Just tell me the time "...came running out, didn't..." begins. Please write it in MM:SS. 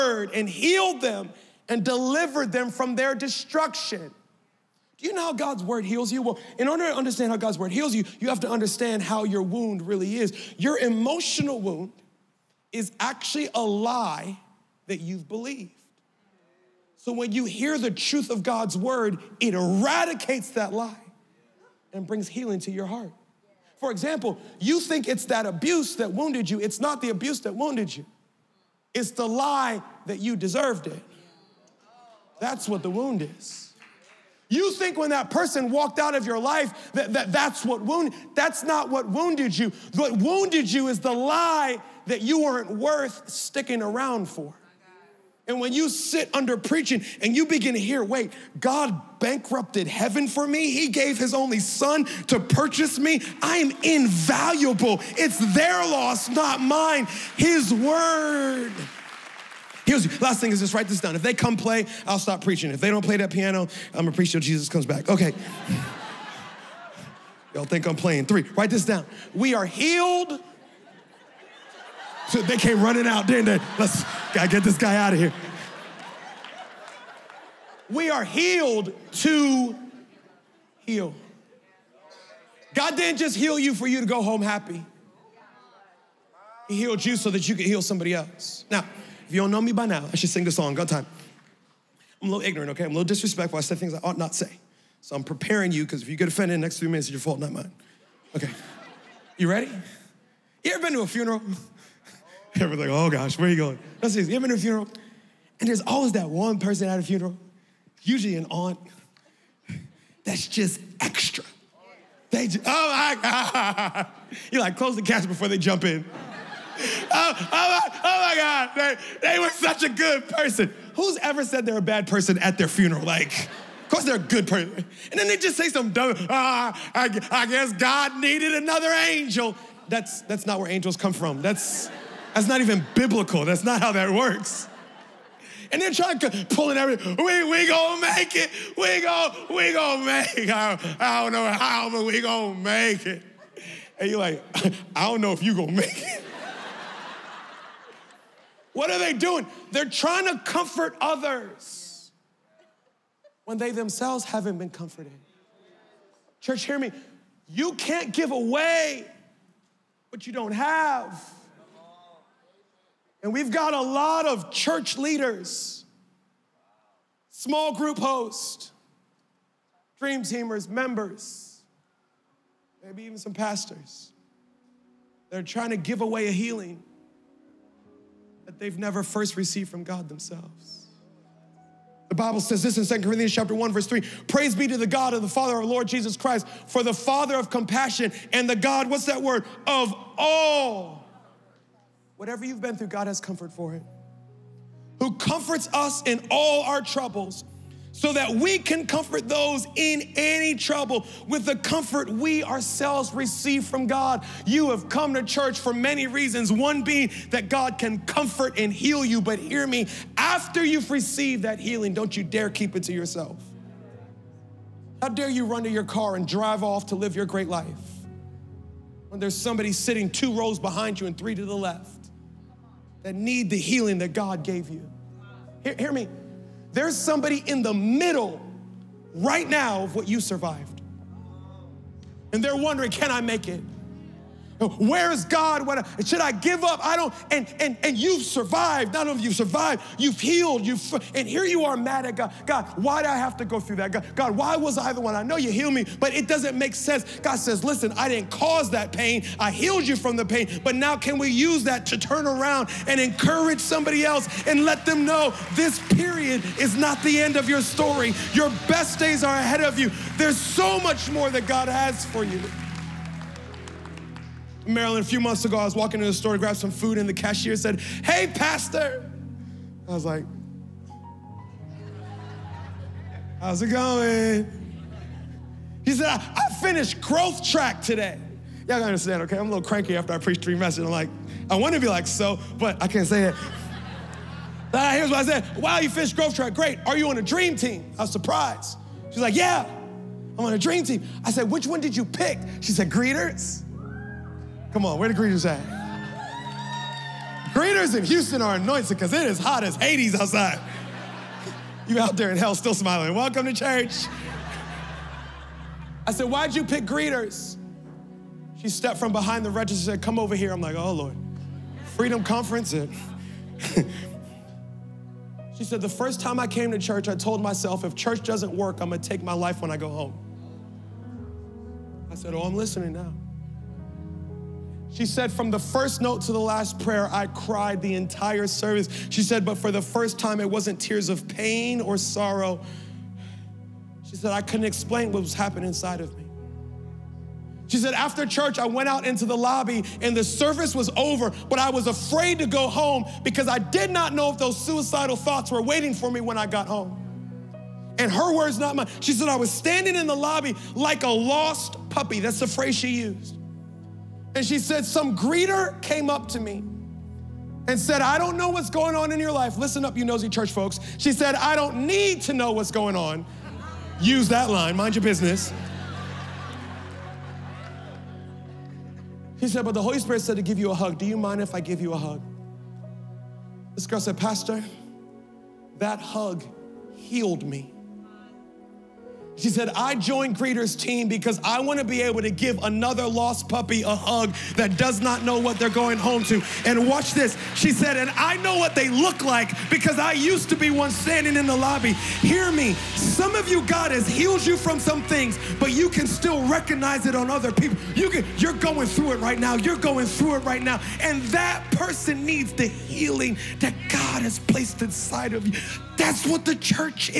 01:12.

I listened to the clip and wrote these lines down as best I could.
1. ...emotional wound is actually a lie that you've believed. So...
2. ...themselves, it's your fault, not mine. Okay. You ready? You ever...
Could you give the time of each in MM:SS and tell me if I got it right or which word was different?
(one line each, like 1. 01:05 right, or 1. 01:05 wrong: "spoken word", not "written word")
1. 00:10 right
2. 01:36 wrong: "minutes", not "themselves".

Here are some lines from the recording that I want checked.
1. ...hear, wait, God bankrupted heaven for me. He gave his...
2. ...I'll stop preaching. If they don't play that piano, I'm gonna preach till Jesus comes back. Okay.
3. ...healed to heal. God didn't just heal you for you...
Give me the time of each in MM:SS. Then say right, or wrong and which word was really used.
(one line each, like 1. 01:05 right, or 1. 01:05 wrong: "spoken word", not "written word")
1. 00:47 right
2. 01:02 right
3. 01:18 right.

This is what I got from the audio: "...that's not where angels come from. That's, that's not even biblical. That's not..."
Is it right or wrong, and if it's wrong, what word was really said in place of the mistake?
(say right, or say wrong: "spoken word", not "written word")
right.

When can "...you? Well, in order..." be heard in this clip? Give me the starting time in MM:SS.
00:06.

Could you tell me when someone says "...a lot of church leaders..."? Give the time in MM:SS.
02:43.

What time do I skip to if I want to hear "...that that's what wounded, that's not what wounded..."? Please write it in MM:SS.
00:37.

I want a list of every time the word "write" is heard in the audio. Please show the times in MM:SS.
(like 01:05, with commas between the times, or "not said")
01:00, 01:08.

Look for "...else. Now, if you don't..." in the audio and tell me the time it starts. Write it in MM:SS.
01:28.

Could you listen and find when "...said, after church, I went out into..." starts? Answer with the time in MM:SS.
05:37.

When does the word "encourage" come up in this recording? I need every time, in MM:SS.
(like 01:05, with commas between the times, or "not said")
04:12.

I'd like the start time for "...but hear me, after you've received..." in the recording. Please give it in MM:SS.
03:29.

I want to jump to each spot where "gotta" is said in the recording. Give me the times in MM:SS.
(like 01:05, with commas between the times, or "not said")
01:14, 04:38.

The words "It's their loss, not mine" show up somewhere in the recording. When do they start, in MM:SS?
00:55.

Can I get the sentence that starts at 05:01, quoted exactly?
You out there in hell still smiling.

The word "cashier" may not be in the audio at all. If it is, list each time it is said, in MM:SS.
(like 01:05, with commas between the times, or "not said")
04:27.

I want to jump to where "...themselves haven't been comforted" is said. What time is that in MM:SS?
02:33.